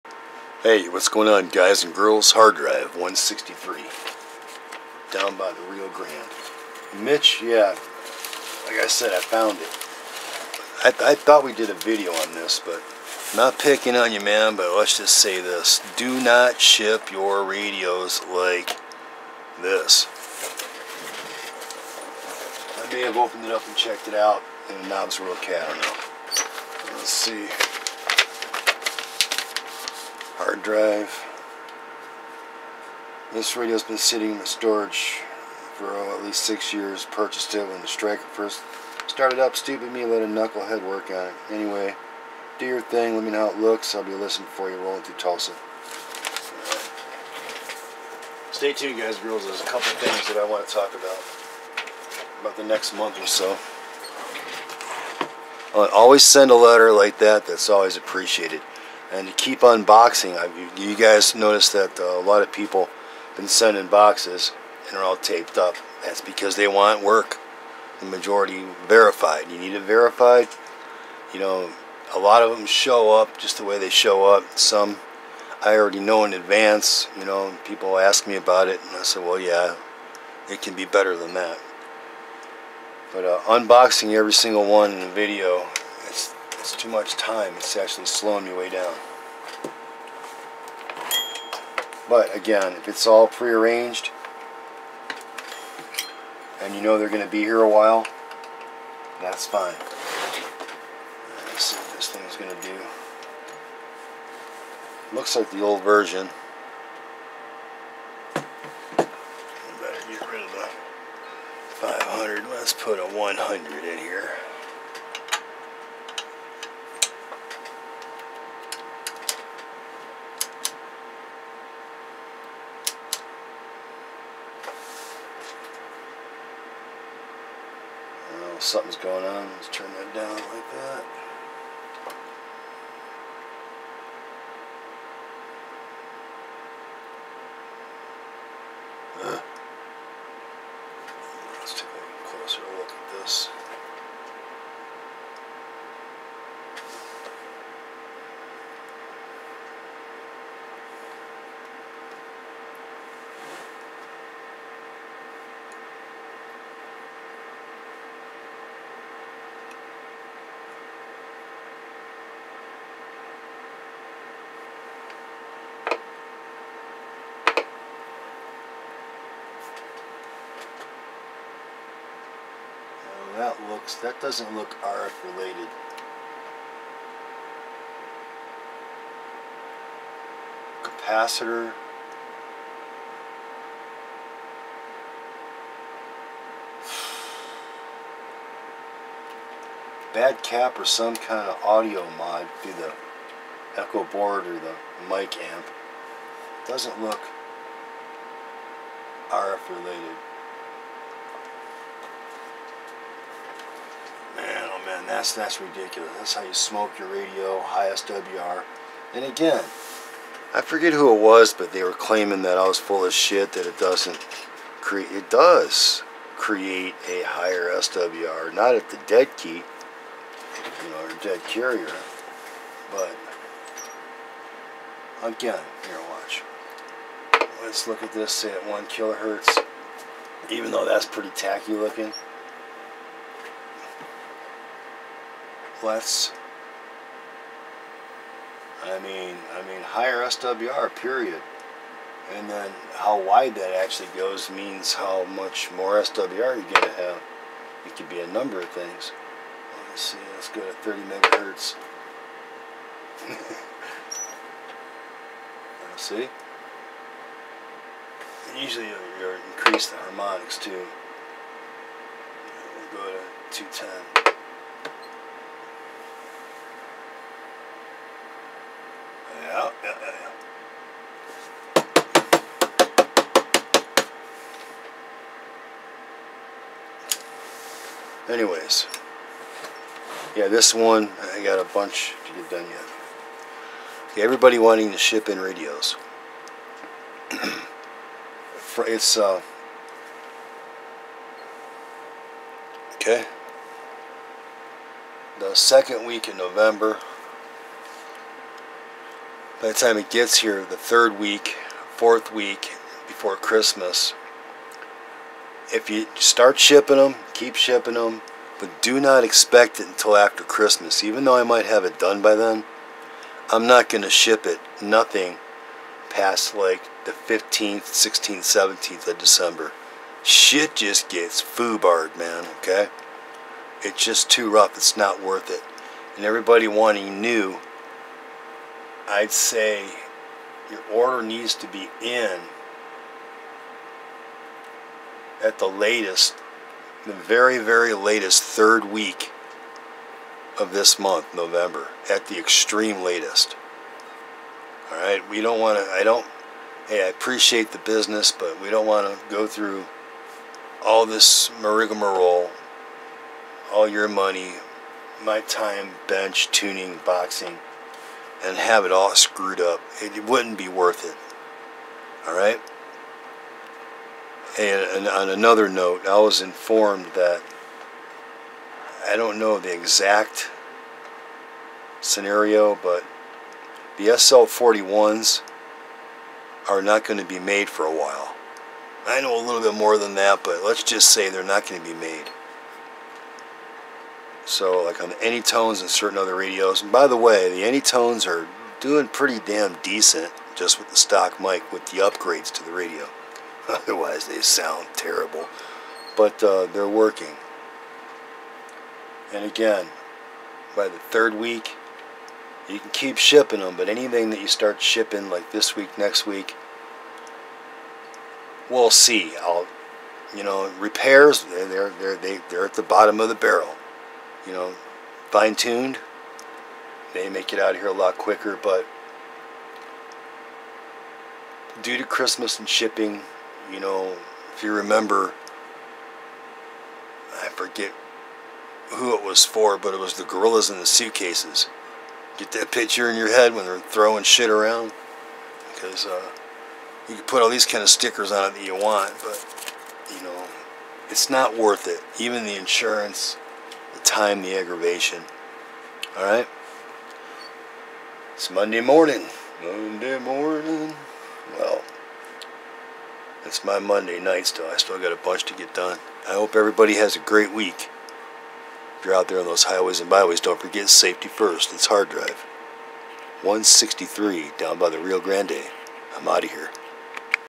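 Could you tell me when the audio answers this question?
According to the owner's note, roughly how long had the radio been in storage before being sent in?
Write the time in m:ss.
0:36.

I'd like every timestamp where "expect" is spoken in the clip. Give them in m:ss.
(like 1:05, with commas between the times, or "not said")
5:09.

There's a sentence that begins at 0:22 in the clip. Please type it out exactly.
I may have opened it up and checked it out, and the knobs were okay, I don't know.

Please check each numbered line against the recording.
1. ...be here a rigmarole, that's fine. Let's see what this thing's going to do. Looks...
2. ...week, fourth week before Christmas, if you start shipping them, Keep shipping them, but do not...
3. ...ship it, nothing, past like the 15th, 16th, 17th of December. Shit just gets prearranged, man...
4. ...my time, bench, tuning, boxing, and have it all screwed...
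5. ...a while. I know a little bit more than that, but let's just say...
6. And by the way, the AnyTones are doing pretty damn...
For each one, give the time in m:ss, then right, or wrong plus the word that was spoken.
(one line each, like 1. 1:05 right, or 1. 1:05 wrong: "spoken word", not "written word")
1. 1:37 wrong: "while", not "rigmarole"
2. 5:01 right
3. 5:14 wrong: "foobarred", not "prearranged"
4. 5:55 right
5. 6:17 right
6. 6:26 right.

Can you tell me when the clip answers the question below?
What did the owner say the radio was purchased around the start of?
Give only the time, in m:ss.
0:37.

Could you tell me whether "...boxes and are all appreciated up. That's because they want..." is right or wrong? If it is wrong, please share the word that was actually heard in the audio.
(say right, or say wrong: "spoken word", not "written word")
wrong: "taped", not "appreciated".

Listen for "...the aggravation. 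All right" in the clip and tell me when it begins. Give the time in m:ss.
7:24.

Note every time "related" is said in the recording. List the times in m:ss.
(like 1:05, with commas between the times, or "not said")
2:55, 3:19.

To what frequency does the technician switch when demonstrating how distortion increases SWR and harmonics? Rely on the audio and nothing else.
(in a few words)
30 megahertz.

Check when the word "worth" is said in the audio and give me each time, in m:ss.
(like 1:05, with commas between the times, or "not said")
5:25, 6:00, 7:21.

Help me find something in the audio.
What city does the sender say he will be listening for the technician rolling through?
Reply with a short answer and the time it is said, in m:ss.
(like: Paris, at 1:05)
Tulsa, at 0:45.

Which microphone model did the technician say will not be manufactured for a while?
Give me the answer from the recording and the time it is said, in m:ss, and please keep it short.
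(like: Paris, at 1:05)
SL 41, at 6:14.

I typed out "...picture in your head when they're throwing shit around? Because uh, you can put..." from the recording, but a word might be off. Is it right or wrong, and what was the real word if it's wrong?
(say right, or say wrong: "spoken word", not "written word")
right.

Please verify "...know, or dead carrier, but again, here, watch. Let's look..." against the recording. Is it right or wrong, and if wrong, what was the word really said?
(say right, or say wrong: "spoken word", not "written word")
right.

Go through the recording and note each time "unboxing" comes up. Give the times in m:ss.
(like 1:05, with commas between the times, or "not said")
0:59, 1:23.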